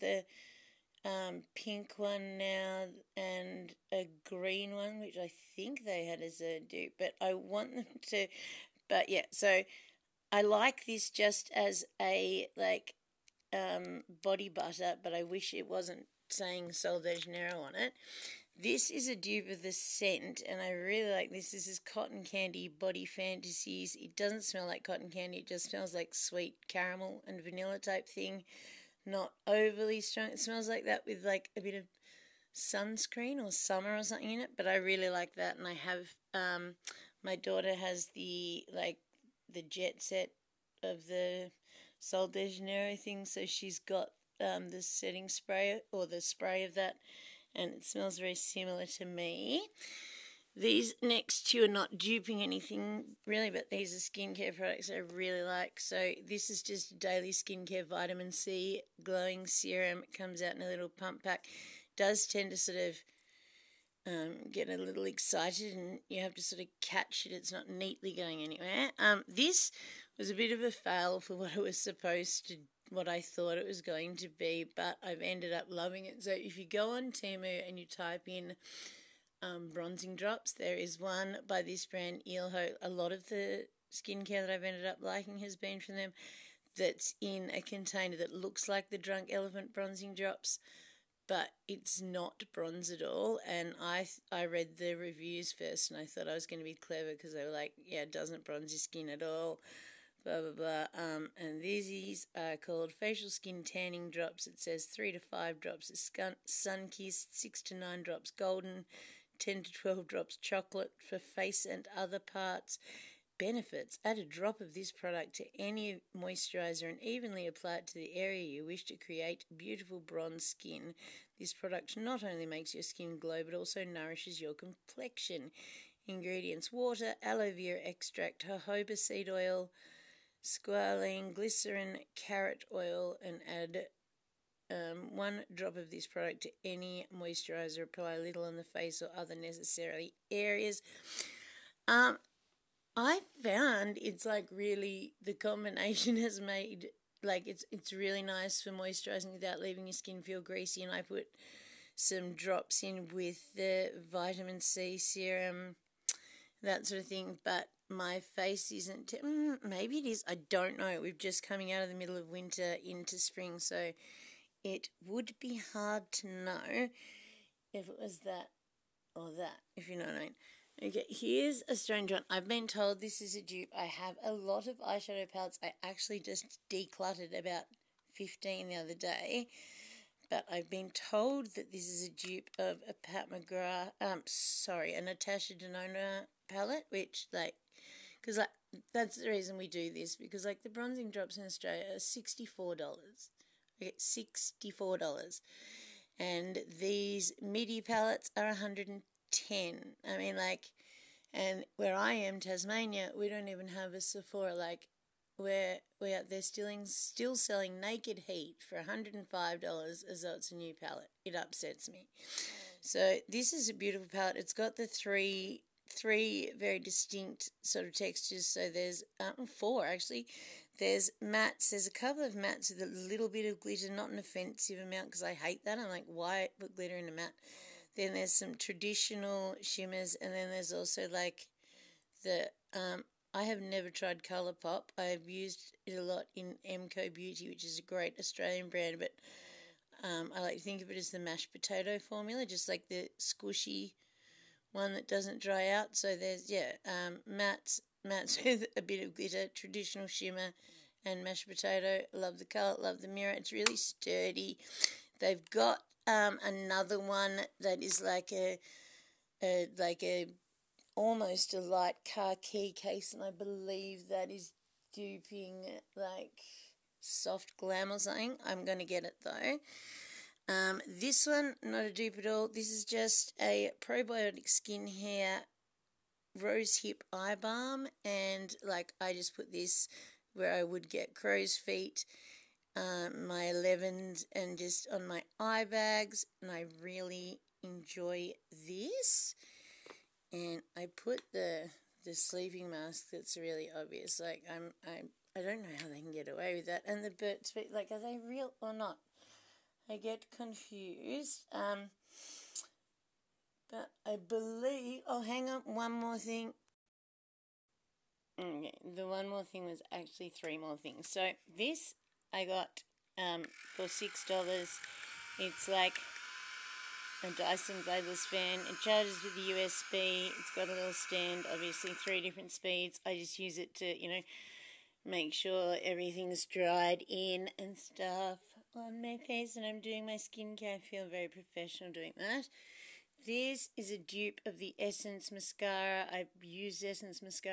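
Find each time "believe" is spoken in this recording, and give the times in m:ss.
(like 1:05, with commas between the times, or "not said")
4:23, 5:04.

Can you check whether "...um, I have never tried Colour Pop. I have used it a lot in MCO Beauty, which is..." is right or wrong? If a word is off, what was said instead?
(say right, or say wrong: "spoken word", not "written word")
right.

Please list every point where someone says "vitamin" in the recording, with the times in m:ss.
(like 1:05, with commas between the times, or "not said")
0:57, 2:34.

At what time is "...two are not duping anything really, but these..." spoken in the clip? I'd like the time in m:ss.
0:51.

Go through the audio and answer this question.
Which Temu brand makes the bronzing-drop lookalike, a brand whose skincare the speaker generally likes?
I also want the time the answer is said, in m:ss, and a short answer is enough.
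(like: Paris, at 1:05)
Ilho, at 1:22.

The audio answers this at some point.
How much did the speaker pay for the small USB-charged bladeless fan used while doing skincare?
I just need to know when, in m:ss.
5:13.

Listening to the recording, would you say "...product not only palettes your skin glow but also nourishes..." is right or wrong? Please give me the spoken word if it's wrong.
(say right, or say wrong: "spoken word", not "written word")
wrong: "makes", not "palettes".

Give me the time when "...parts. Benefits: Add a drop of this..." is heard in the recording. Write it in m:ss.
1:52.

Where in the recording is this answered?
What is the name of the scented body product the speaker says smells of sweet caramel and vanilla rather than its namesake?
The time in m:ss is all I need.
0:21.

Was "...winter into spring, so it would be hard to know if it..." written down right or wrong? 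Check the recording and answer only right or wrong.
right.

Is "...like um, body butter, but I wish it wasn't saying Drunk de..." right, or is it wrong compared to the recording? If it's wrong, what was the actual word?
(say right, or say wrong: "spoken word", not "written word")
wrong: "Sol", not "Drunk".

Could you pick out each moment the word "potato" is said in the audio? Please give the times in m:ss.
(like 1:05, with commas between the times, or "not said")
4:01, 4:11.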